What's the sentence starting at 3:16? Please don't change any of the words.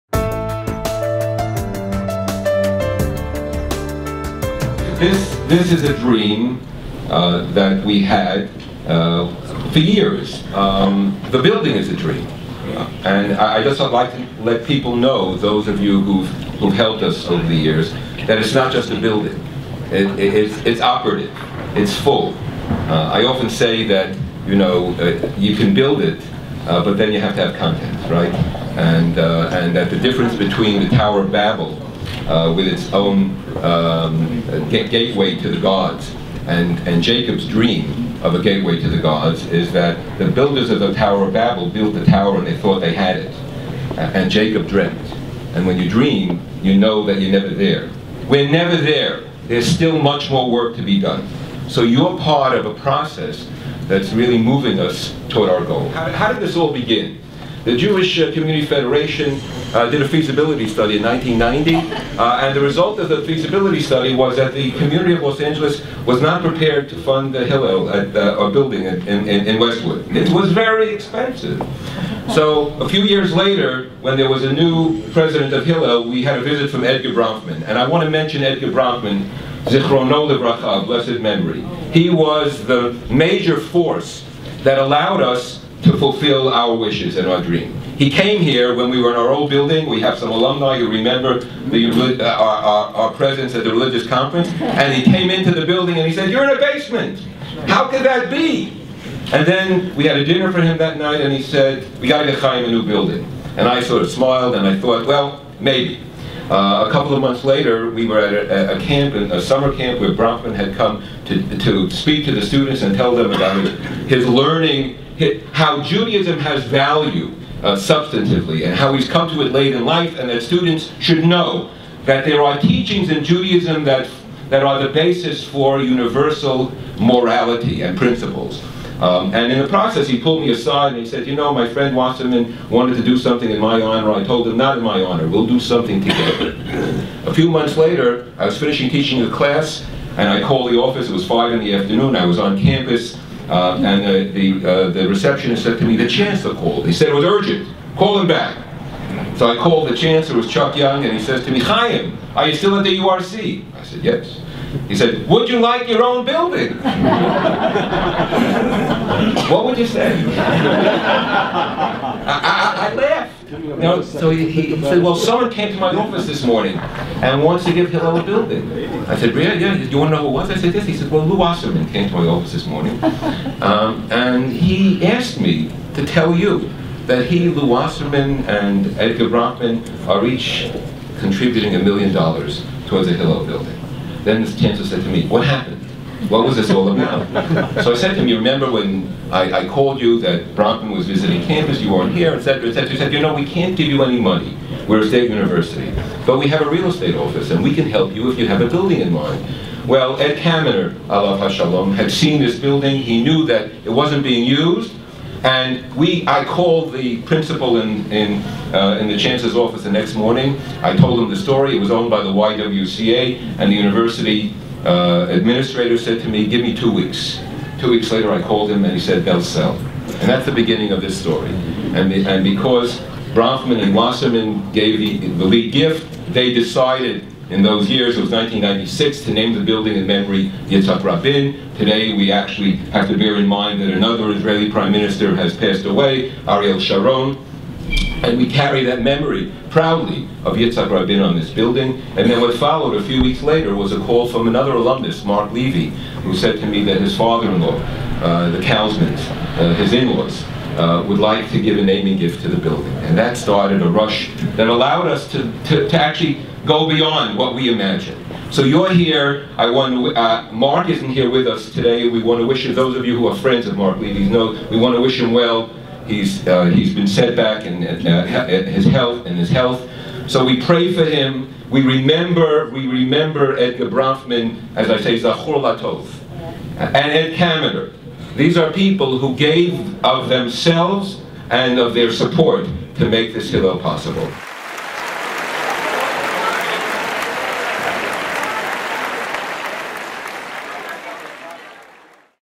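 But we have a real estate office, and we can help you if you have a building in mind.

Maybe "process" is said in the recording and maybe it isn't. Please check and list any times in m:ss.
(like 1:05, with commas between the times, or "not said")
0:52, 2:09.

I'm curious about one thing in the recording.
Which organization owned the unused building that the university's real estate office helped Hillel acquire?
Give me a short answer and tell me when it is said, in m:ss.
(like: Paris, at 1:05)
YWCA, at 3:32.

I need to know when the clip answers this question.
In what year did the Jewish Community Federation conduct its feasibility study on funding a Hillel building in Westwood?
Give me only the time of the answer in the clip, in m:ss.
1:01.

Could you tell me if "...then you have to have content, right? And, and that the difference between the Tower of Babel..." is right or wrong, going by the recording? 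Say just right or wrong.
right.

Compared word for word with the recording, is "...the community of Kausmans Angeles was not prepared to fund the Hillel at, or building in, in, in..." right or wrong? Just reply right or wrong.
wrong.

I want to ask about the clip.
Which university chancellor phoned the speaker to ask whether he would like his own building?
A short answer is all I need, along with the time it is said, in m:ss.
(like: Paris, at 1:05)
Chuck Young, at 2:30.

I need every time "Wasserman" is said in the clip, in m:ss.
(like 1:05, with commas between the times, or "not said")
2:11, 2:51, 2:57, 3:43.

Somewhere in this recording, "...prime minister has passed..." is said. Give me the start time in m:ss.
3:54.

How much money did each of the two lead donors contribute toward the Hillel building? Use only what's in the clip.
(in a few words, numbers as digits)
a million dollars.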